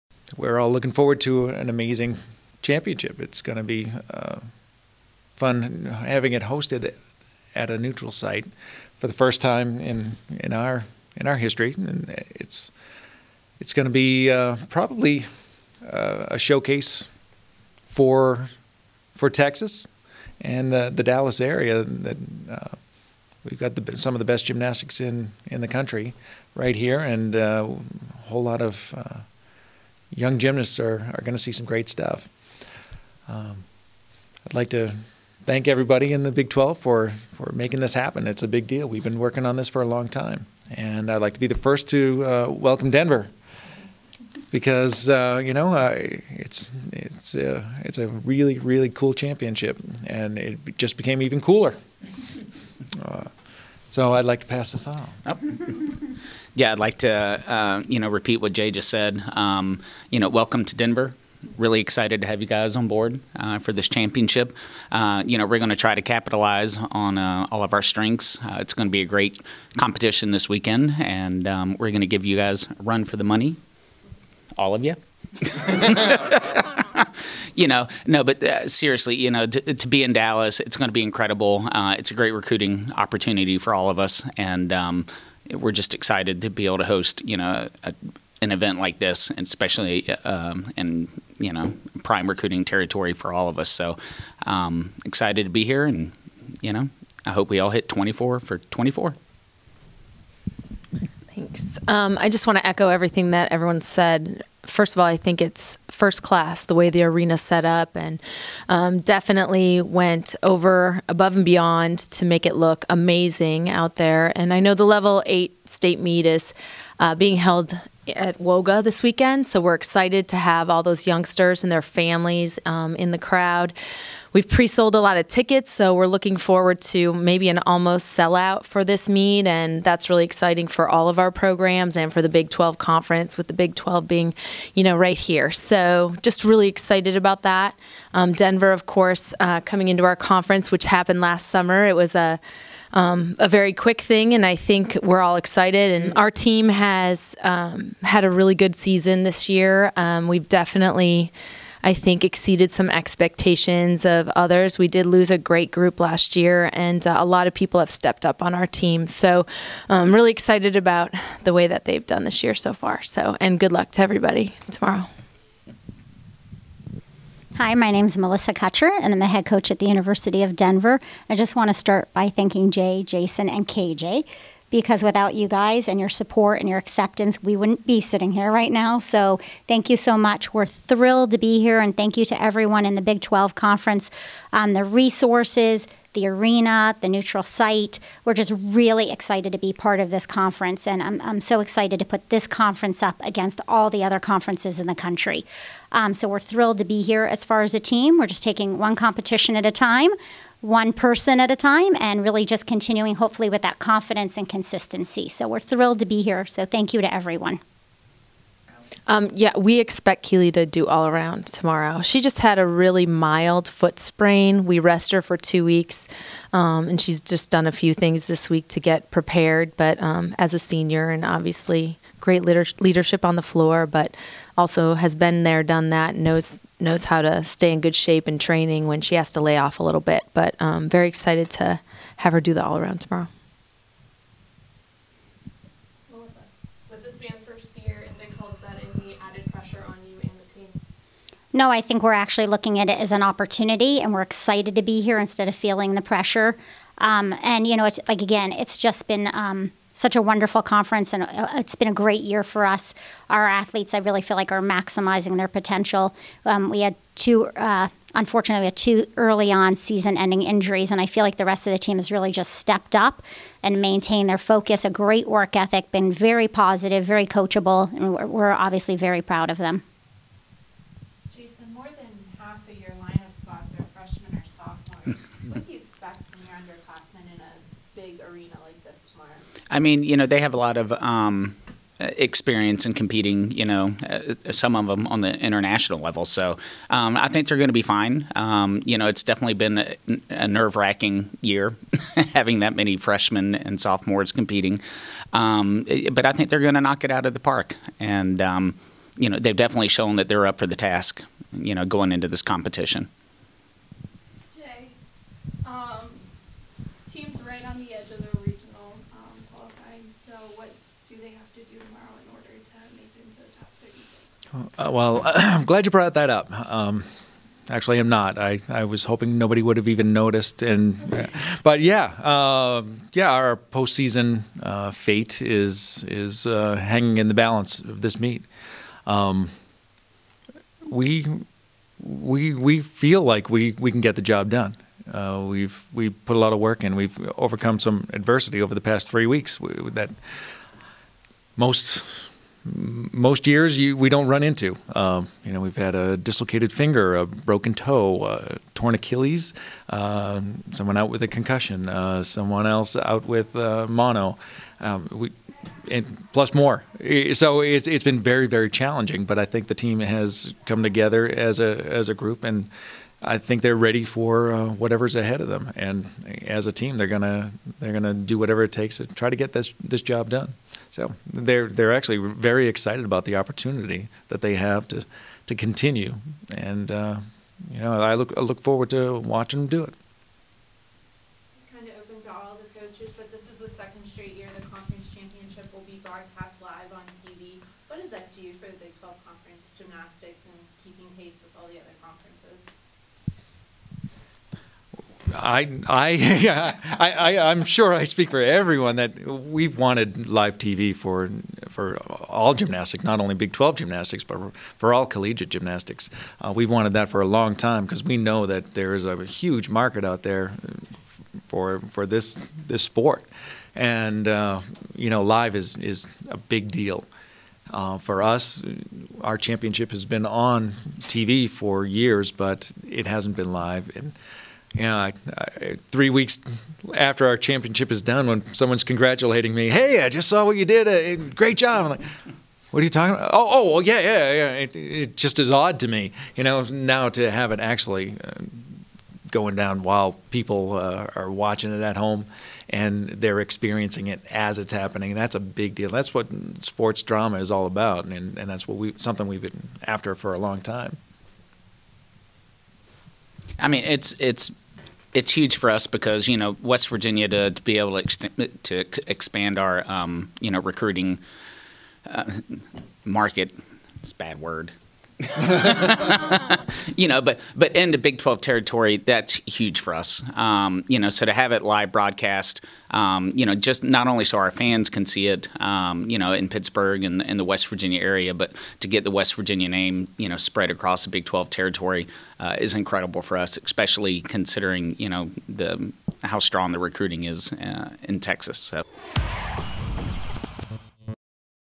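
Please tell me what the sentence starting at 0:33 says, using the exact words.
Um, I'd like to thank everybody in the Big 12 for, for making this happen.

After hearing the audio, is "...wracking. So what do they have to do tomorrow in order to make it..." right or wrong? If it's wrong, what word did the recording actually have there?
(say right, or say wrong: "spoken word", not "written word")
wrong: "qualifying", not "wracking".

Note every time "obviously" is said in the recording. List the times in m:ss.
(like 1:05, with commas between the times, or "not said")
3:41, 4:28.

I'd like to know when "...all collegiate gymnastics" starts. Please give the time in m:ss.
6:44.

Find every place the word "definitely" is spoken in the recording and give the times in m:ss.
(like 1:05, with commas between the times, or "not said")
1:49, 2:30, 4:49, 4:59.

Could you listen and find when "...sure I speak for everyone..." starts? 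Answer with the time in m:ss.
6:37.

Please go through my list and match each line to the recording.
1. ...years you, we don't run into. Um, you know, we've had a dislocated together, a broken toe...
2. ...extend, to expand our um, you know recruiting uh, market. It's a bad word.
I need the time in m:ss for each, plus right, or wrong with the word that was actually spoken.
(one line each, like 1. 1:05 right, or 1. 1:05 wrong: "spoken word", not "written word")
1. 5:43 wrong: "finger", not "together"
2. 7:37 right.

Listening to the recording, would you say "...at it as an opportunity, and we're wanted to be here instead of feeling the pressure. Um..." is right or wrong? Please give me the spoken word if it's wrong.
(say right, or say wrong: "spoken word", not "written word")
wrong: "excited", not "wanted".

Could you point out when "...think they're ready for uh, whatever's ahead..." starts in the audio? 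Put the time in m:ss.
6:03.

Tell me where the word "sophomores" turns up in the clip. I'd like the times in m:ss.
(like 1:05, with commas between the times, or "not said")
4:34, 4:53.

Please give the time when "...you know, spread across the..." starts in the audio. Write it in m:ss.
8:00.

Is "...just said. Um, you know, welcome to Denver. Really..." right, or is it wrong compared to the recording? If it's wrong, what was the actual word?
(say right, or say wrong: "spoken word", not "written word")
right.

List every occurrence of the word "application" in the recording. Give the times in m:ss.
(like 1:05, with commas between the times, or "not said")
not said.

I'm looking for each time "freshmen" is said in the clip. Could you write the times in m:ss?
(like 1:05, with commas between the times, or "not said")
4:33, 4:52.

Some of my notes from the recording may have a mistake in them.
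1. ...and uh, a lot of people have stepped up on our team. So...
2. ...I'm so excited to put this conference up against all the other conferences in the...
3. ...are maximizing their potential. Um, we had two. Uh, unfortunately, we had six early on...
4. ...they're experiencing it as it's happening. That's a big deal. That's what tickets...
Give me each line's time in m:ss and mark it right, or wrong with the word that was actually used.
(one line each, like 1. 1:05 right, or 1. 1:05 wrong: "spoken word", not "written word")
1. 2:36 right
2. 3:11 right
3. 4:14 wrong: "two", not "six"
4. 7:23 wrong: "sports", not "tickets".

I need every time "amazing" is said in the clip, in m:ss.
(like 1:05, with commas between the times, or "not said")
0:01, 1:52.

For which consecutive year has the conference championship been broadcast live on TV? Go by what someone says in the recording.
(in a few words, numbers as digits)
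Second.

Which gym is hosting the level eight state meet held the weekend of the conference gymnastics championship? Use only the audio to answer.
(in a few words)
WOGA.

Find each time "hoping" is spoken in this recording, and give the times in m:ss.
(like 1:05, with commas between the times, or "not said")
5:19.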